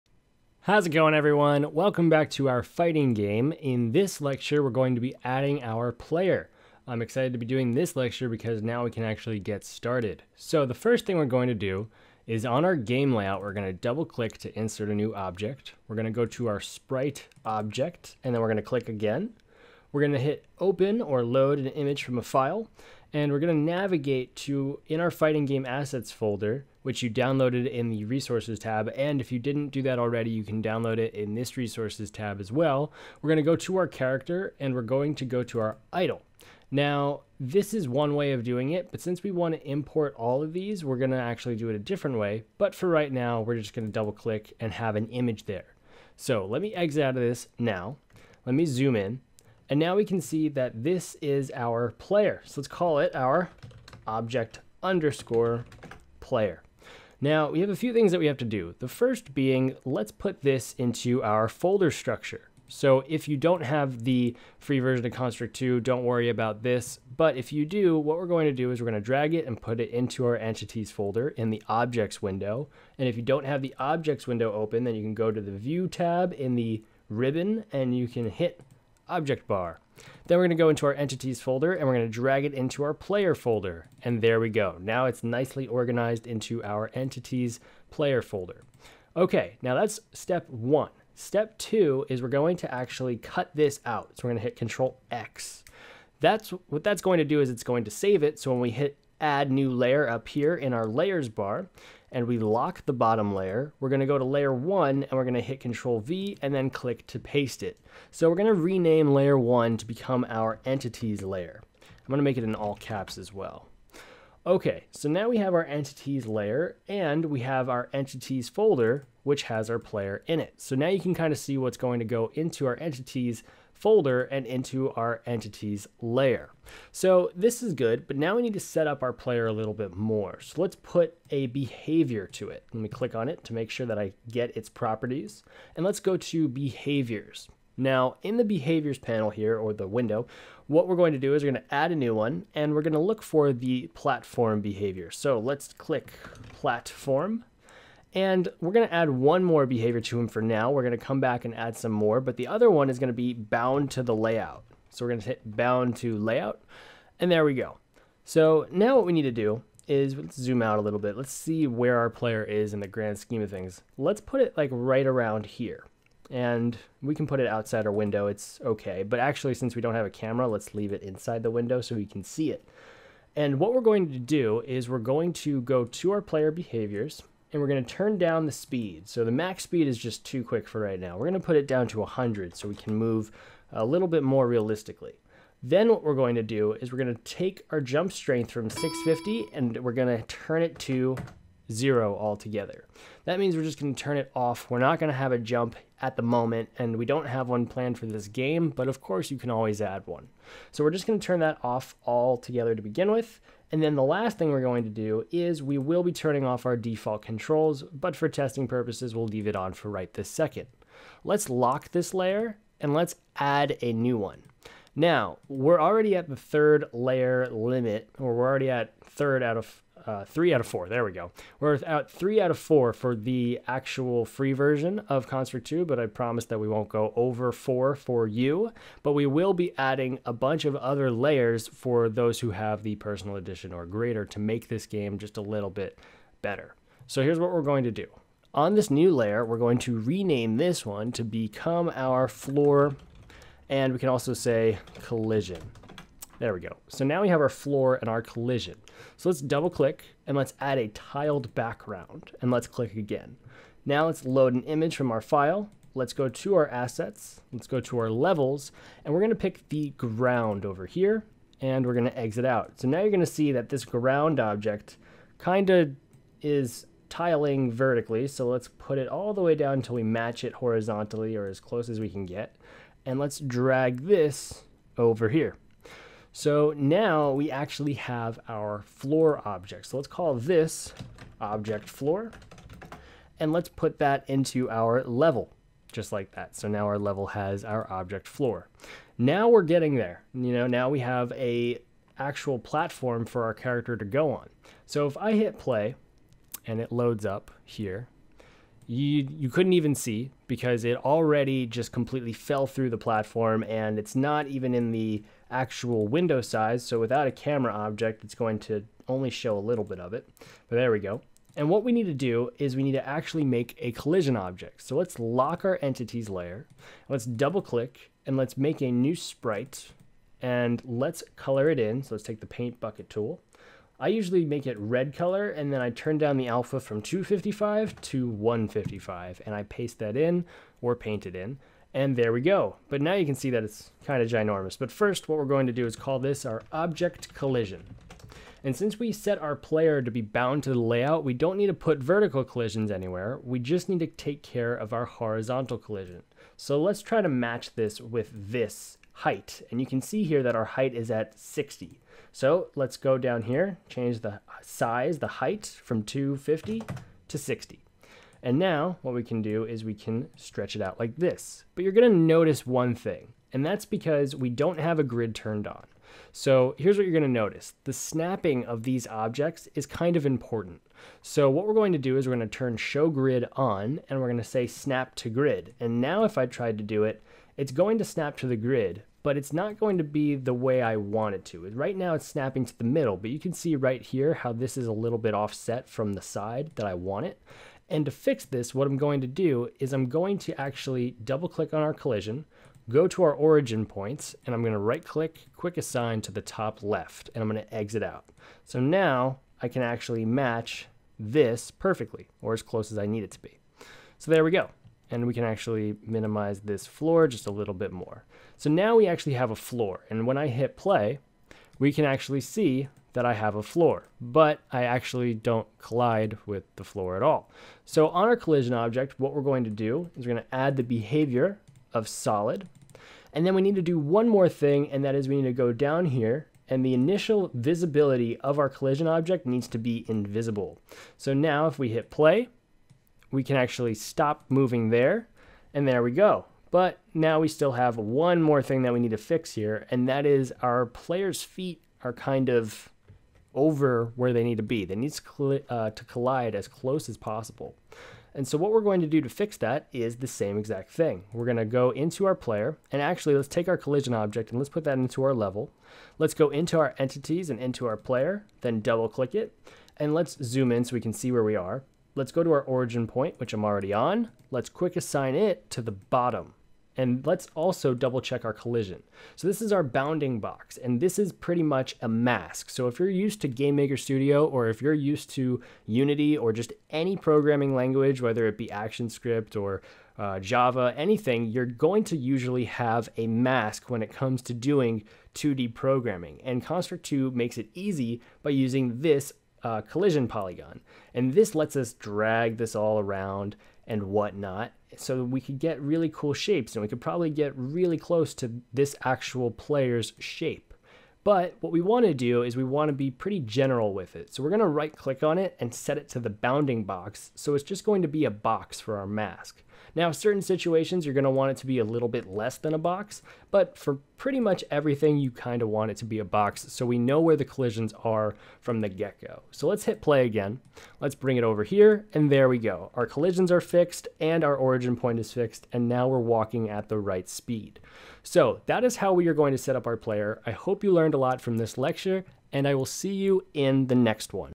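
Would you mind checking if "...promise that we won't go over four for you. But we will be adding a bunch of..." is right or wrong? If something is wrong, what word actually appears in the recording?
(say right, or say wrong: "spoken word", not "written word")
right.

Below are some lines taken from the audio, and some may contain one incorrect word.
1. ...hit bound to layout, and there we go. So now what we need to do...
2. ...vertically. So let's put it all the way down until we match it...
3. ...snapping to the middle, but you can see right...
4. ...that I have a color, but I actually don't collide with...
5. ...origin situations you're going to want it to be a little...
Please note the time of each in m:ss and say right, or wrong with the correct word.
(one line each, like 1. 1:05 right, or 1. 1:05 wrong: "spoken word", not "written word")
1. 2:35 right
2. 4:27 right
3. 6:22 right
4. 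6:53 wrong: "floor", not "color"
5. 8:30 wrong: "certain", not "origin".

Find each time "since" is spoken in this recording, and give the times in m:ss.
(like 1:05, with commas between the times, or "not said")
0:39, 2:49, 5:38.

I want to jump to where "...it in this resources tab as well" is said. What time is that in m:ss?
0:30.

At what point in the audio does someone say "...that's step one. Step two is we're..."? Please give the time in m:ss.
1:29.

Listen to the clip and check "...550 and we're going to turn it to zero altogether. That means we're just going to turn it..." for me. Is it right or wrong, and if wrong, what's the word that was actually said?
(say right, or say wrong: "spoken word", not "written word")
wrong: "650", not "550".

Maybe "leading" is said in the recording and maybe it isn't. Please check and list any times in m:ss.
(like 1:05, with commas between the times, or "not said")
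not said.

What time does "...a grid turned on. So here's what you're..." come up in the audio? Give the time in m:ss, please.
6:04.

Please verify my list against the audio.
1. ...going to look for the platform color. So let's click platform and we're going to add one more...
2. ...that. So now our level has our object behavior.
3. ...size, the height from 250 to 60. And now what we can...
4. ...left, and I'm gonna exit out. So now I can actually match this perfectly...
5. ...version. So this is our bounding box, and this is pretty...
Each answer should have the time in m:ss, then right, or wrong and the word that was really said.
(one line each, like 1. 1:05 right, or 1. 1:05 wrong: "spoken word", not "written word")
1. 2:22 wrong: "behavior", not "color"
2. 4:46 wrong: "floor", not "behavior"
3. 5:54 right
4. 6:36 right
5. 7:48 wrong: "collision", not "version".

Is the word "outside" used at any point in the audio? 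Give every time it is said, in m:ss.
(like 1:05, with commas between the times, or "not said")
2:47.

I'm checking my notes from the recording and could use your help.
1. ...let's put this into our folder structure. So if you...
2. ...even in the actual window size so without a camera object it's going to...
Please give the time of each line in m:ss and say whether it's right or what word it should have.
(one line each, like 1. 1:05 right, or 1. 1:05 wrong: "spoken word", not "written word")
1. 0:59 right
2. 5:04 right.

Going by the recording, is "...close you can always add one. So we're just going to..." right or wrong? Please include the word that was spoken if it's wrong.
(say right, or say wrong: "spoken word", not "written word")
wrong: "course", not "close".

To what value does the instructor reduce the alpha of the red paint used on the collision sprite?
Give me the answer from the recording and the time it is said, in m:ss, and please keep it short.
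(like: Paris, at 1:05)
155, at 5:28.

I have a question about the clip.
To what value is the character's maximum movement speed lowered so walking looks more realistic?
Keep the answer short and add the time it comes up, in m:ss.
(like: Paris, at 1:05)
100, at 3:01.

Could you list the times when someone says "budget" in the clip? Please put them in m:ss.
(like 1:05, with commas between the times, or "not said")
not said.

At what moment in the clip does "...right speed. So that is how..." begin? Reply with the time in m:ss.
8:46.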